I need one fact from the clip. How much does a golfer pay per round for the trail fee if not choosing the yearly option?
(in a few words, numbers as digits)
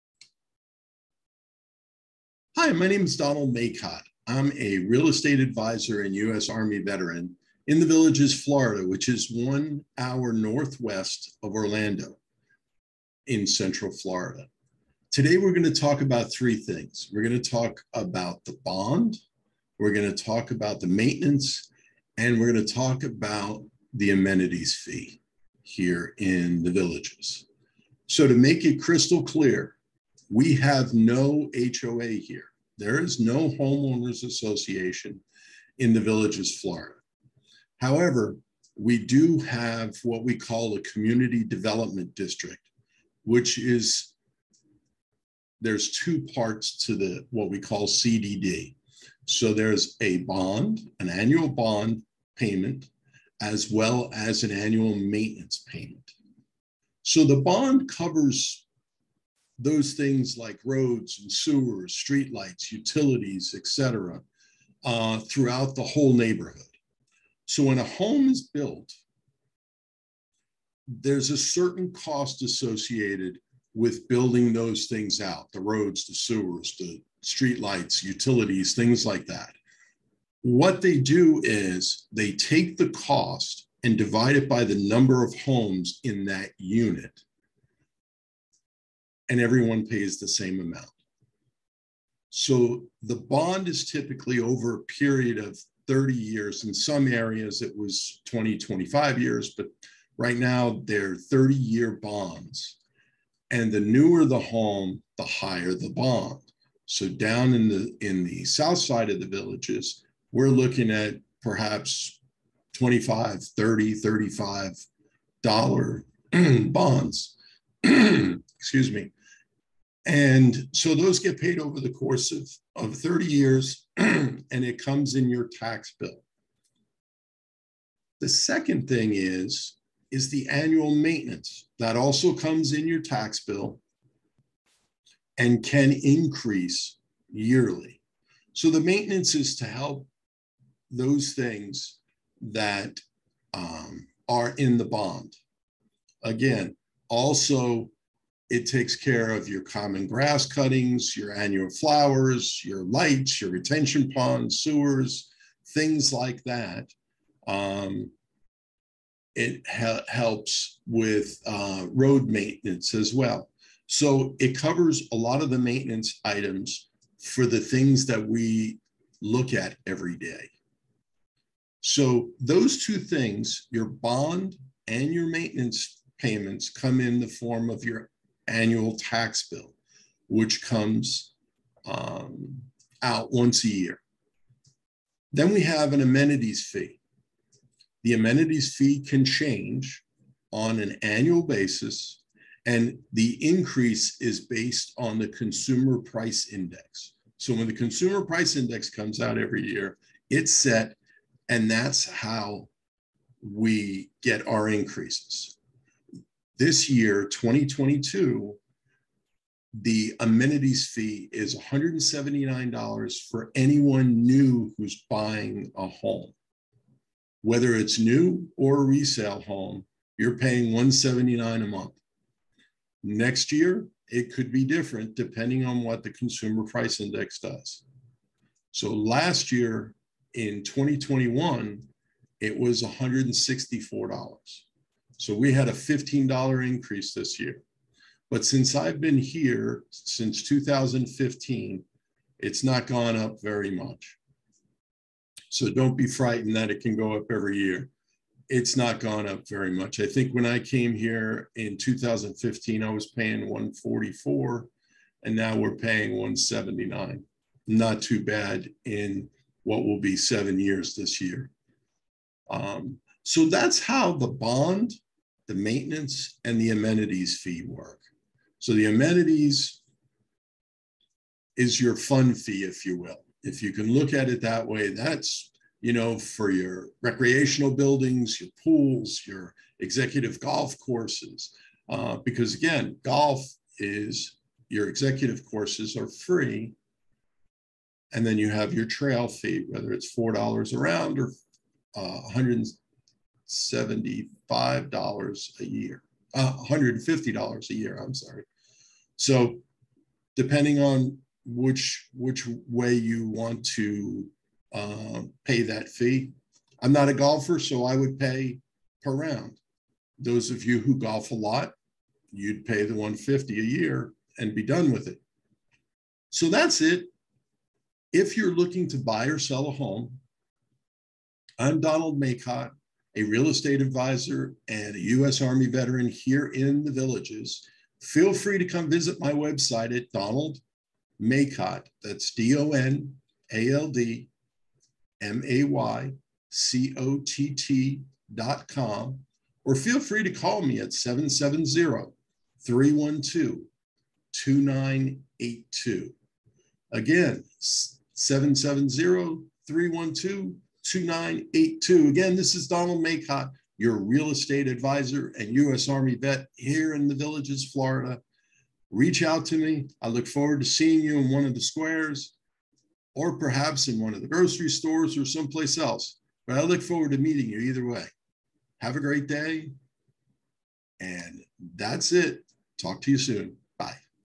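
$4.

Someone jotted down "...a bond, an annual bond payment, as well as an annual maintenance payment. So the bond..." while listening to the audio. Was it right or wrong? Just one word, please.
right.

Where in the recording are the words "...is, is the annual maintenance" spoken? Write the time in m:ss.
2:09.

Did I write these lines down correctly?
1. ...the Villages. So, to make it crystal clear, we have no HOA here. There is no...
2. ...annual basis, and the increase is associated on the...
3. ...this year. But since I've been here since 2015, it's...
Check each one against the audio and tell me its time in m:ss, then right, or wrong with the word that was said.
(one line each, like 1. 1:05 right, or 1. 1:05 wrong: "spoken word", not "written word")
1. 0:26 right
2. 3:11 wrong: "based", not "associated"
3. 3:57 right.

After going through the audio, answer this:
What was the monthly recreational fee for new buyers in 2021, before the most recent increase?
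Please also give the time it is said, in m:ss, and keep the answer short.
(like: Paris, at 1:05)
$164, at 3:52.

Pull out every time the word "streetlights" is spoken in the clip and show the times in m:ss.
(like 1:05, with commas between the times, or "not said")
1:01, 1:17.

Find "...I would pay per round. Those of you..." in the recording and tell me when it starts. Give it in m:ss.
5:07.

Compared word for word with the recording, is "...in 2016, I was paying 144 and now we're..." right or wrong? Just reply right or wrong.
wrong.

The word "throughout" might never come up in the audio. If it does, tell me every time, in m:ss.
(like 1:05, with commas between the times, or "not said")
1:05.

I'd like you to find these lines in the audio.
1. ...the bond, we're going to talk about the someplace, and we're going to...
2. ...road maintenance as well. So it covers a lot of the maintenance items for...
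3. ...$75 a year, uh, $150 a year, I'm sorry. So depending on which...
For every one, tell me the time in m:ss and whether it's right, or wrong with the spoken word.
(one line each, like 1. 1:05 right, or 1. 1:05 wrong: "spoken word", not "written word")
1. 0:18 wrong: "maintenance", not "someplace"
2. 2:41 right
3. 4:53 right.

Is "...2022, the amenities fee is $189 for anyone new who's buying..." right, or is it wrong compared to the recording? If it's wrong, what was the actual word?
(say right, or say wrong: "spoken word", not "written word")
wrong: "179", not "189".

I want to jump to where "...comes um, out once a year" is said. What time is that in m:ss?
3:00.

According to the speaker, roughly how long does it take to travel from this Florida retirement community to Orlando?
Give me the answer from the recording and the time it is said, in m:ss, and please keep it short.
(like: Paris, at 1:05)
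1 hour, at 0:09.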